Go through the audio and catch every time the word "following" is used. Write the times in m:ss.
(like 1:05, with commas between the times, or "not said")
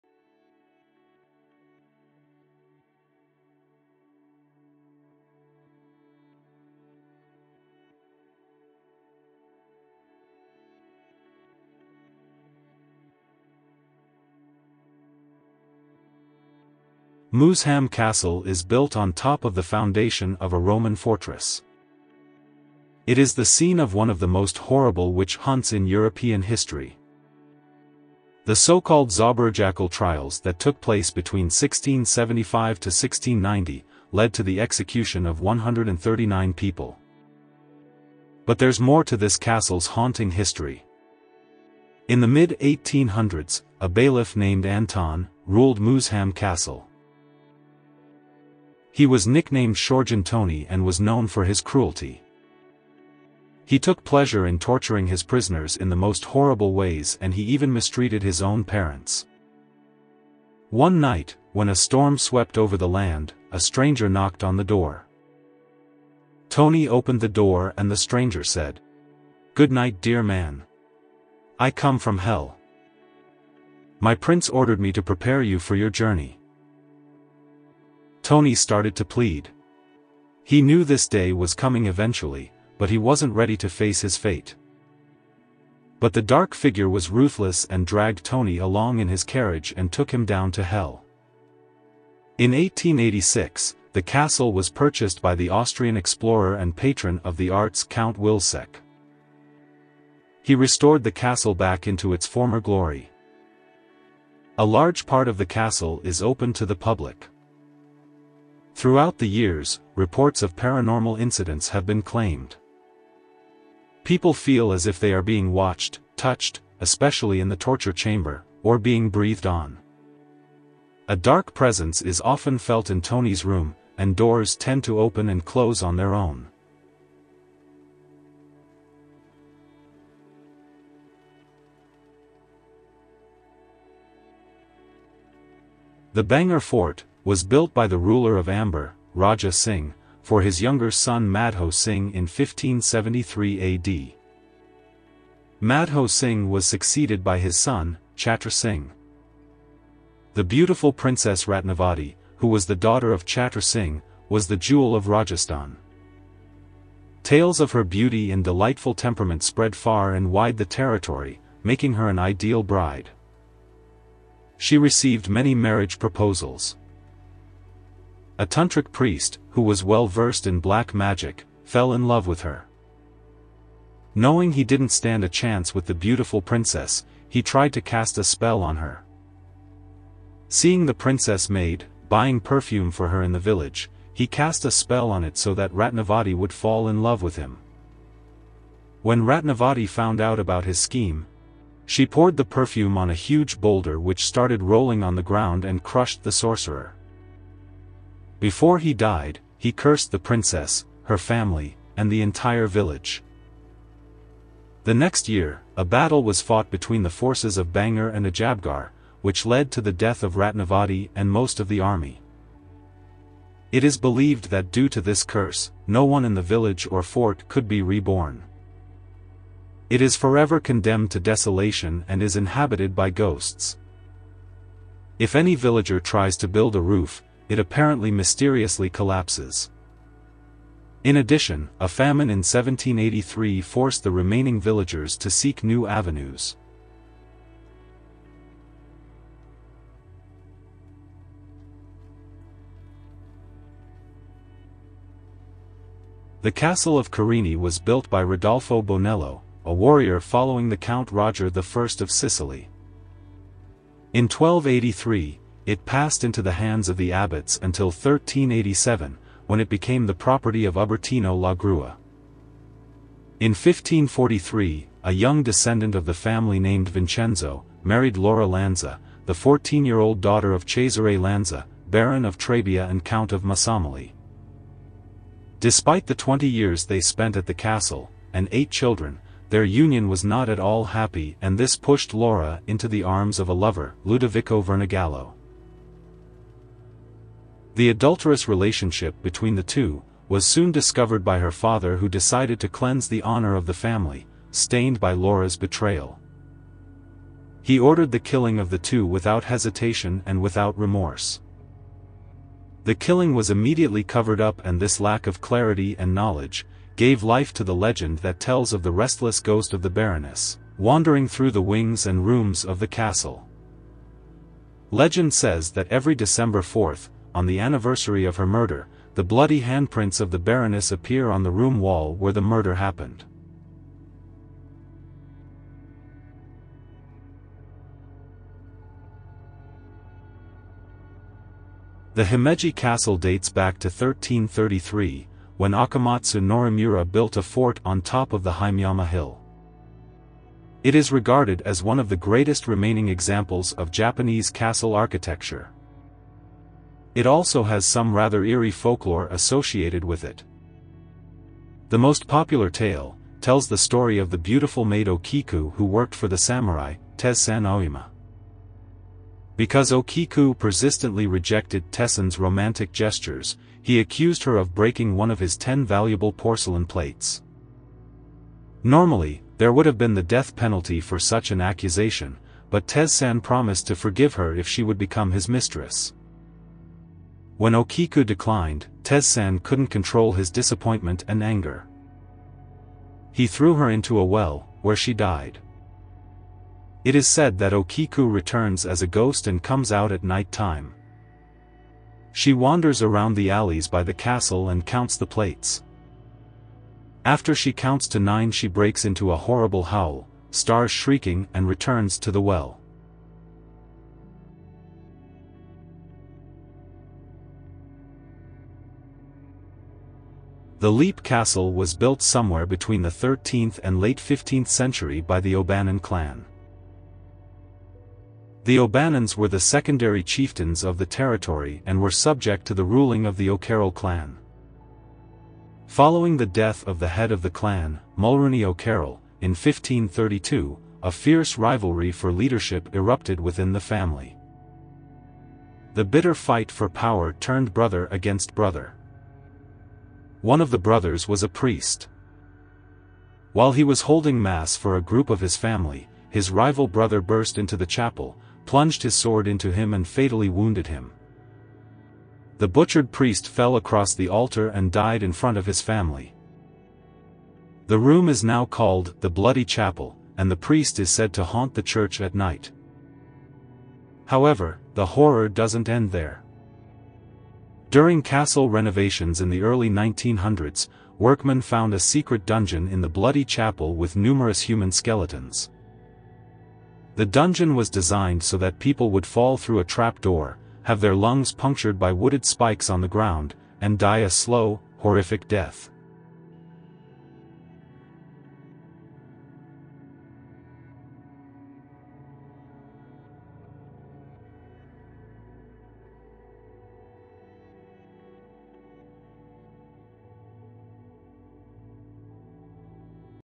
4:10, 7:05.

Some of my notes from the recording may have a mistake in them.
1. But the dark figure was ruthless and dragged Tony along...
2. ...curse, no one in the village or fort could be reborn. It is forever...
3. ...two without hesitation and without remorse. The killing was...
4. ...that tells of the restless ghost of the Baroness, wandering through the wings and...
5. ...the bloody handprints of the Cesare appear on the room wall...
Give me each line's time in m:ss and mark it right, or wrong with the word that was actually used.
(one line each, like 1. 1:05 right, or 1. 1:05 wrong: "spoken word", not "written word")
1. 1:25 right
2. 3:35 right
3. 4:58 right
4. 5:08 right
5. 5:19 wrong: "Baroness", not "Cesare".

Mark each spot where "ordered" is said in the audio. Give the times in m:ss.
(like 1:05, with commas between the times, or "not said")
1:14, 4:57.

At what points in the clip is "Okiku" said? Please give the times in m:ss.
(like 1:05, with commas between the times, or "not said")
5:55, 5:59, 6:17, 6:27.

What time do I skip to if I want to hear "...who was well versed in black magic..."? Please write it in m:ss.
2:49.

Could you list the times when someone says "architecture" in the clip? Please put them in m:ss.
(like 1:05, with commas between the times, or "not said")
5:44.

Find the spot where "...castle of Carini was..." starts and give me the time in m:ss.
4:06.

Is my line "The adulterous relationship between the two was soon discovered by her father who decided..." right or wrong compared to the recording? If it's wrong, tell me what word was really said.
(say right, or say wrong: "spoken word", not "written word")
right.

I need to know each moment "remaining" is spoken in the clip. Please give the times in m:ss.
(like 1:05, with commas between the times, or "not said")
3:54, 5:42.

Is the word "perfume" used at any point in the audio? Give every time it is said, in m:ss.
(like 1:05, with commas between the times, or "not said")
3:02, 3:12.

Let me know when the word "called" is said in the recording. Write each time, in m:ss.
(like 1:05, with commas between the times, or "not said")
0:28, 7:38.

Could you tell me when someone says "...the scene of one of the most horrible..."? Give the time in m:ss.
0:23.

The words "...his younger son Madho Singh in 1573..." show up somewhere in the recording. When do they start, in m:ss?
2:20.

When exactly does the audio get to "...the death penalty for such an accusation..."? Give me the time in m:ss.
6:10.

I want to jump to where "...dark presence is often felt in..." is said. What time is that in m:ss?
2:01.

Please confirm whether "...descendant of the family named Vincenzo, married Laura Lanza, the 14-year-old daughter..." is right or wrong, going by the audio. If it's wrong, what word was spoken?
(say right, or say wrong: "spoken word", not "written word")
right.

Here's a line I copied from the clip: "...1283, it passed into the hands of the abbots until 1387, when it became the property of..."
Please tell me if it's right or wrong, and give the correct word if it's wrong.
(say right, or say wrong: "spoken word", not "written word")
right.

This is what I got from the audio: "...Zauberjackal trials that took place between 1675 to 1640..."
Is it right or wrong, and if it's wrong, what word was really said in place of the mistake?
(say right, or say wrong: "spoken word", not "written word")
wrong: "1690", not "1640".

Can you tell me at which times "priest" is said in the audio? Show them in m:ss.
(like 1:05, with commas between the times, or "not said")
2:48, 7:21, 7:33, 7:40.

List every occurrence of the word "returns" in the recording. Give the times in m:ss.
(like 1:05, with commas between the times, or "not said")
6:28, 6:41.